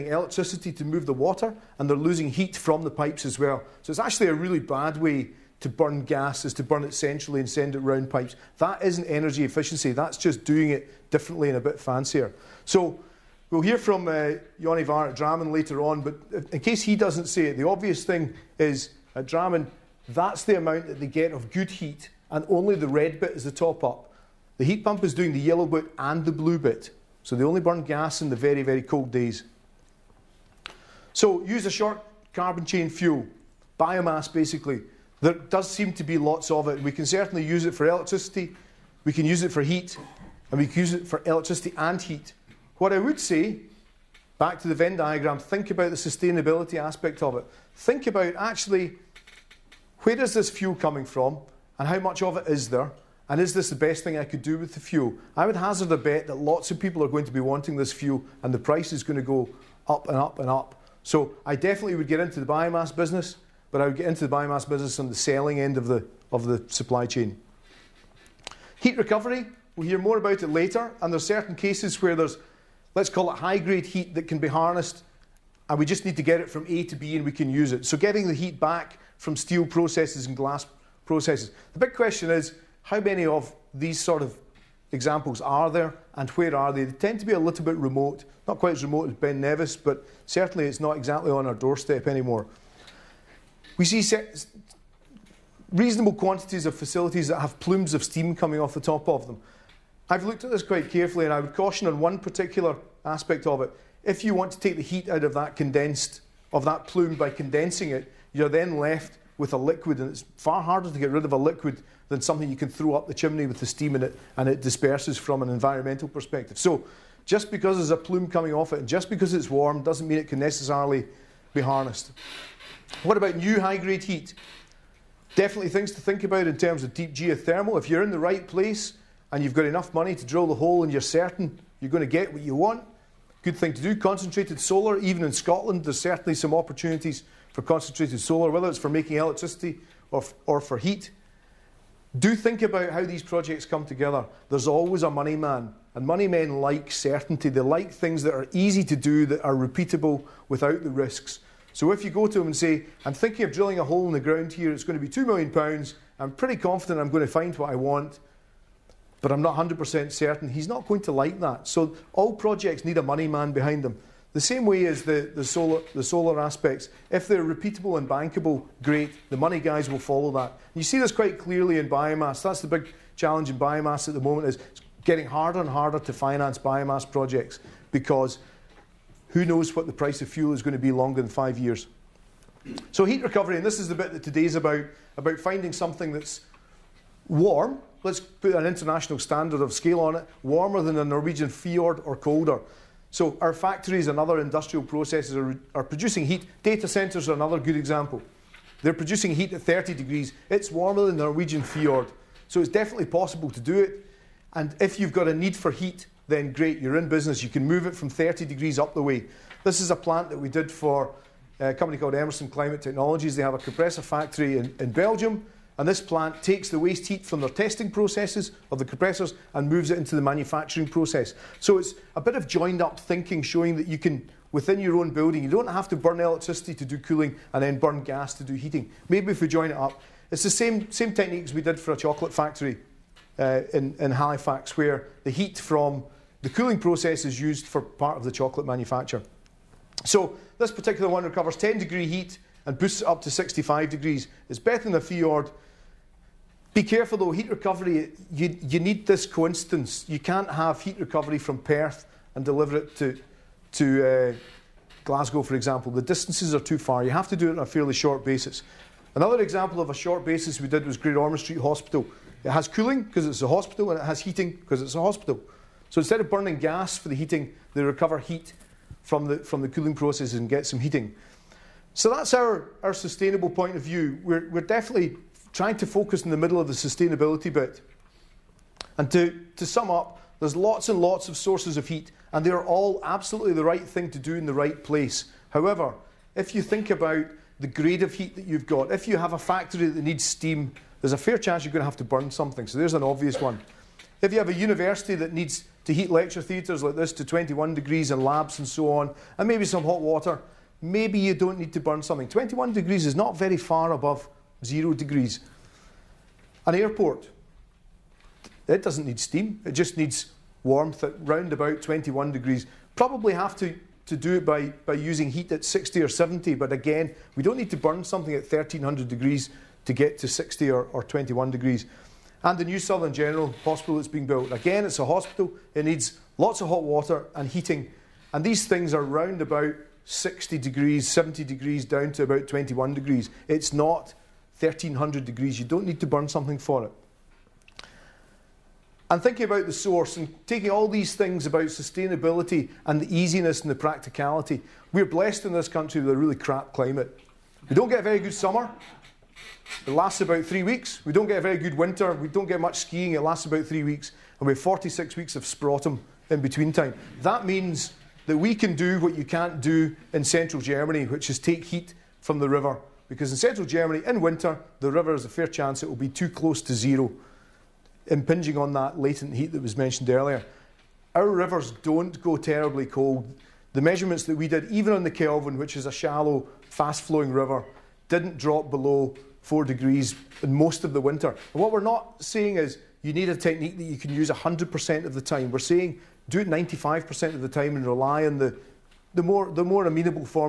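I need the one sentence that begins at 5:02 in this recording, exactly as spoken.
21 degrees is not very far above zero degrees.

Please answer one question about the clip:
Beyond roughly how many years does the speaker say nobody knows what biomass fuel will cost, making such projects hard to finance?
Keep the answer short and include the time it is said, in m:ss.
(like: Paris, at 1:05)
5 years, at 3:01.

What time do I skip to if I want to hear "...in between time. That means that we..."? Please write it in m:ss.
5:56.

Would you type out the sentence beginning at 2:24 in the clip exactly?
There's always a money man, and money men like certainty.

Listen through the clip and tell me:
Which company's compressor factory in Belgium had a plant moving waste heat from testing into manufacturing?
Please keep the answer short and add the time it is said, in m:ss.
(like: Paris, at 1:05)
Emerson Climate Technologies, at 3:32.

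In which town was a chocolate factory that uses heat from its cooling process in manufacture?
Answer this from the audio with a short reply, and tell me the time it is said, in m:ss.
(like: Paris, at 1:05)
Halifax, at 3:54.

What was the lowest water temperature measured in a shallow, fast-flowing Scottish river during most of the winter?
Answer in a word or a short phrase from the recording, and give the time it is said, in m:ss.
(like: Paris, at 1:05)
4 degrees, at 6:19.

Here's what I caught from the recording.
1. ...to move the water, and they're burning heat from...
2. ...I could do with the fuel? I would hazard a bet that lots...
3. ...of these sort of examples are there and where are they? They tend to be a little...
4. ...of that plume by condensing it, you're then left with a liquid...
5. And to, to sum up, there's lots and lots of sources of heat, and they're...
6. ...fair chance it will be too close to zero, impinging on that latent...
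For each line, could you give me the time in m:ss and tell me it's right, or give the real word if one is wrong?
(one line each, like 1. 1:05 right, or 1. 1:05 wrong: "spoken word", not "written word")
1. 0:00 wrong: "losing", not "burning"
2. 0:54 right
3. 1:23 right
4. 1:46 right
5. 4:38 right
6. 6:05 right.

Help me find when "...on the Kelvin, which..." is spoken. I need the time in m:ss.
6:14.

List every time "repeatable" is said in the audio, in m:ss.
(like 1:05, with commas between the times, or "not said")
2:29, 2:47.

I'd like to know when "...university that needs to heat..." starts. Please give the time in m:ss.
4:54.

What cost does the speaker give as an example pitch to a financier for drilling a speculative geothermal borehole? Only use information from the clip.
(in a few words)
£2 million.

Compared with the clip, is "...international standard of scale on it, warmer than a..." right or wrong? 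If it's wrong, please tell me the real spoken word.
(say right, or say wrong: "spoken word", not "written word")
right.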